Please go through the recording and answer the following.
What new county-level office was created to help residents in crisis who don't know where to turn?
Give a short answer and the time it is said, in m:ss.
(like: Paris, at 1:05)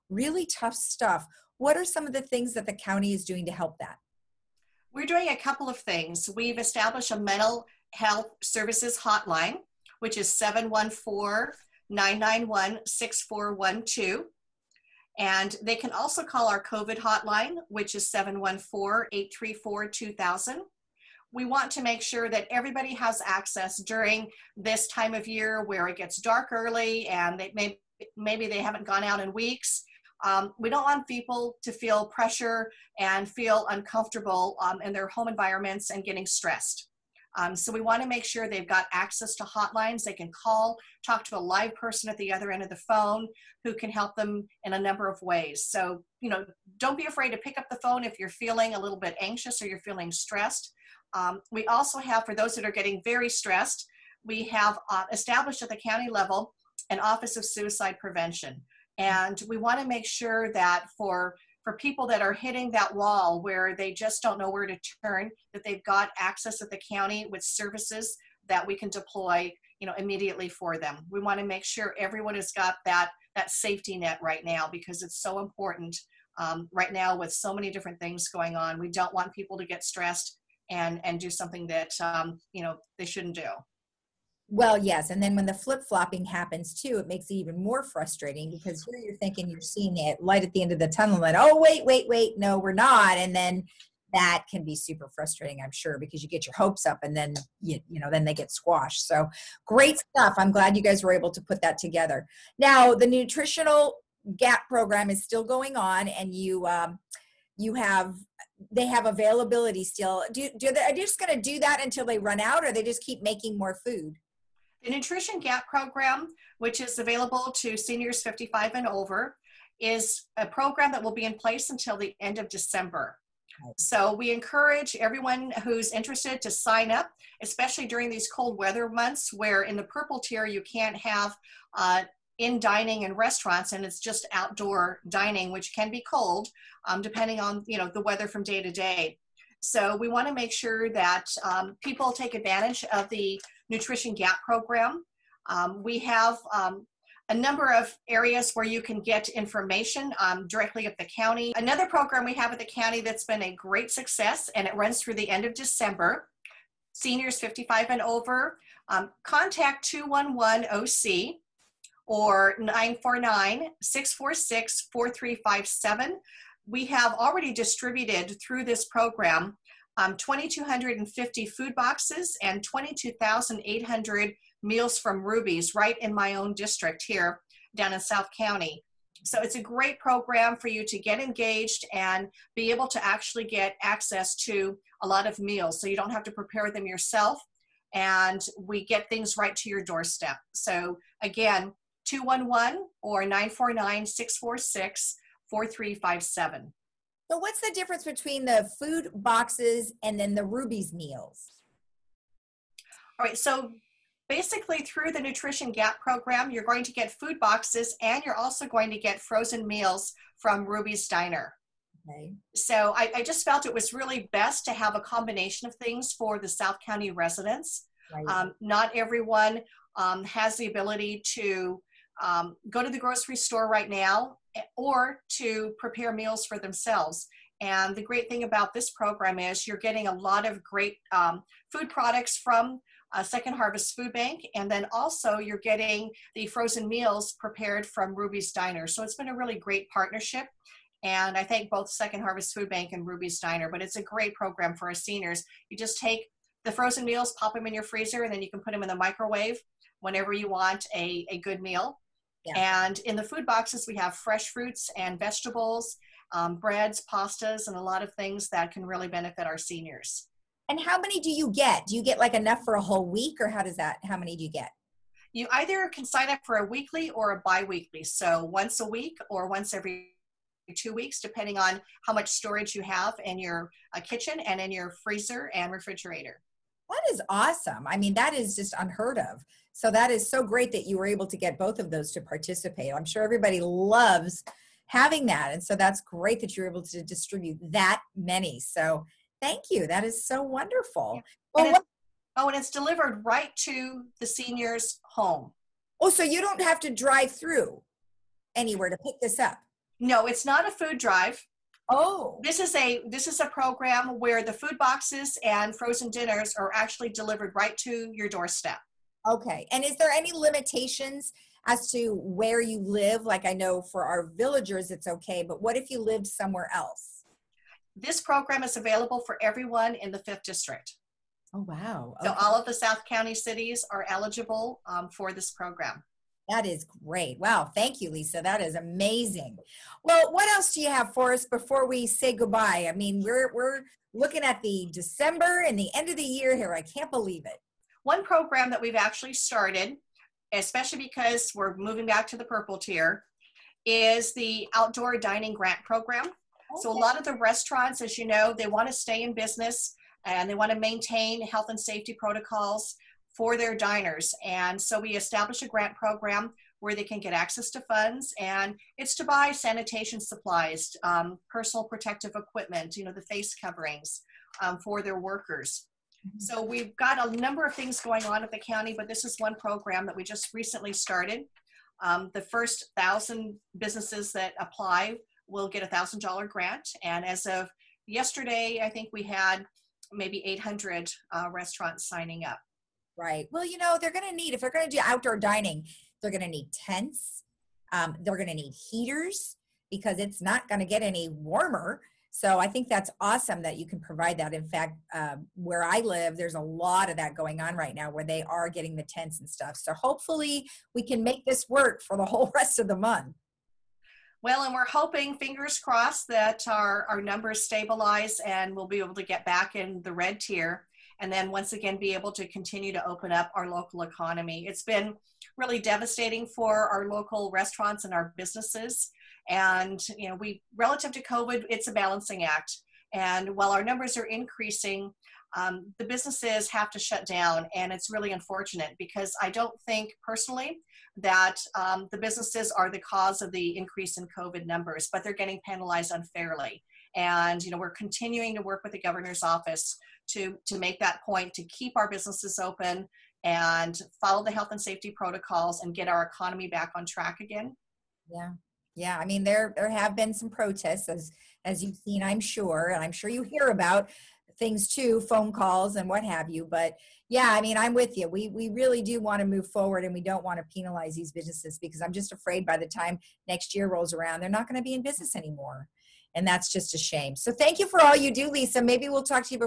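Office of Suicide Prevention, at 0:56.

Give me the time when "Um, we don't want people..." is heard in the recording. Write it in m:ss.
0:30.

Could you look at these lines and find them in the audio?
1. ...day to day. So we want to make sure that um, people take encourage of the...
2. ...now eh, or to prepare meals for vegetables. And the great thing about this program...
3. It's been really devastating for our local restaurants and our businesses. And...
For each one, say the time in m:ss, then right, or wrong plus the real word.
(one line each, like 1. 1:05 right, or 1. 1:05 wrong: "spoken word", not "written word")
1. 2:18 wrong: "advantage", not "encourage"
2. 3:43 wrong: "themselves", not "vegetables"
3. 6:54 right.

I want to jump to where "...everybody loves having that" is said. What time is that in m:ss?
4:43.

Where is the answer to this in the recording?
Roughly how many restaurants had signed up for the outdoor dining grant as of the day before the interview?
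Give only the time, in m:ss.
6:20.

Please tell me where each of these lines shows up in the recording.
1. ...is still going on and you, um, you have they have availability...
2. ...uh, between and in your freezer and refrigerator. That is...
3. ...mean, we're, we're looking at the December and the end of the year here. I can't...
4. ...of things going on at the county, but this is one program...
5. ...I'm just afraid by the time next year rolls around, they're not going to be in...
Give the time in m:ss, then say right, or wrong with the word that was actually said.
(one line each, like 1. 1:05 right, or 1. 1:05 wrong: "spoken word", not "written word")
1. 1:45 right
2. 4:33 wrong: "kitchen", not "between"
3. 5:32 right
4. 6:07 right
5. 7:41 right.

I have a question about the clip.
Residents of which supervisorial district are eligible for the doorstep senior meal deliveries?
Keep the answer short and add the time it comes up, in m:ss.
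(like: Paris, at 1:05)
5th district, at 5:20.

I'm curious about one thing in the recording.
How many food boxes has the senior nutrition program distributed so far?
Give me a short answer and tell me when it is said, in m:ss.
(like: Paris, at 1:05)
2,250, at 2:50.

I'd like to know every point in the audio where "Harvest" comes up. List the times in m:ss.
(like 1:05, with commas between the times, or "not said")
3:53, 4:02.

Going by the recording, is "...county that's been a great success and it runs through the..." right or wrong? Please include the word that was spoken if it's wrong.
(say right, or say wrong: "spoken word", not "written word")
right.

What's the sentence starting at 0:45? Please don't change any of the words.
So, you know, don't be afraid to pick up the phone if you're feeling a little bit anxious or you're feeling stressed.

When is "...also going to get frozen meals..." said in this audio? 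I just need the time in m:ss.
3:28.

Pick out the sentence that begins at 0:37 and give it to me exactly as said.
Um, so we want to make sure they've got access to hotlines.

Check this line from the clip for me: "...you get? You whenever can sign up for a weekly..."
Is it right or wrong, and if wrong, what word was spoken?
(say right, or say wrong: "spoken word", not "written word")
wrong: "either", not "whenever".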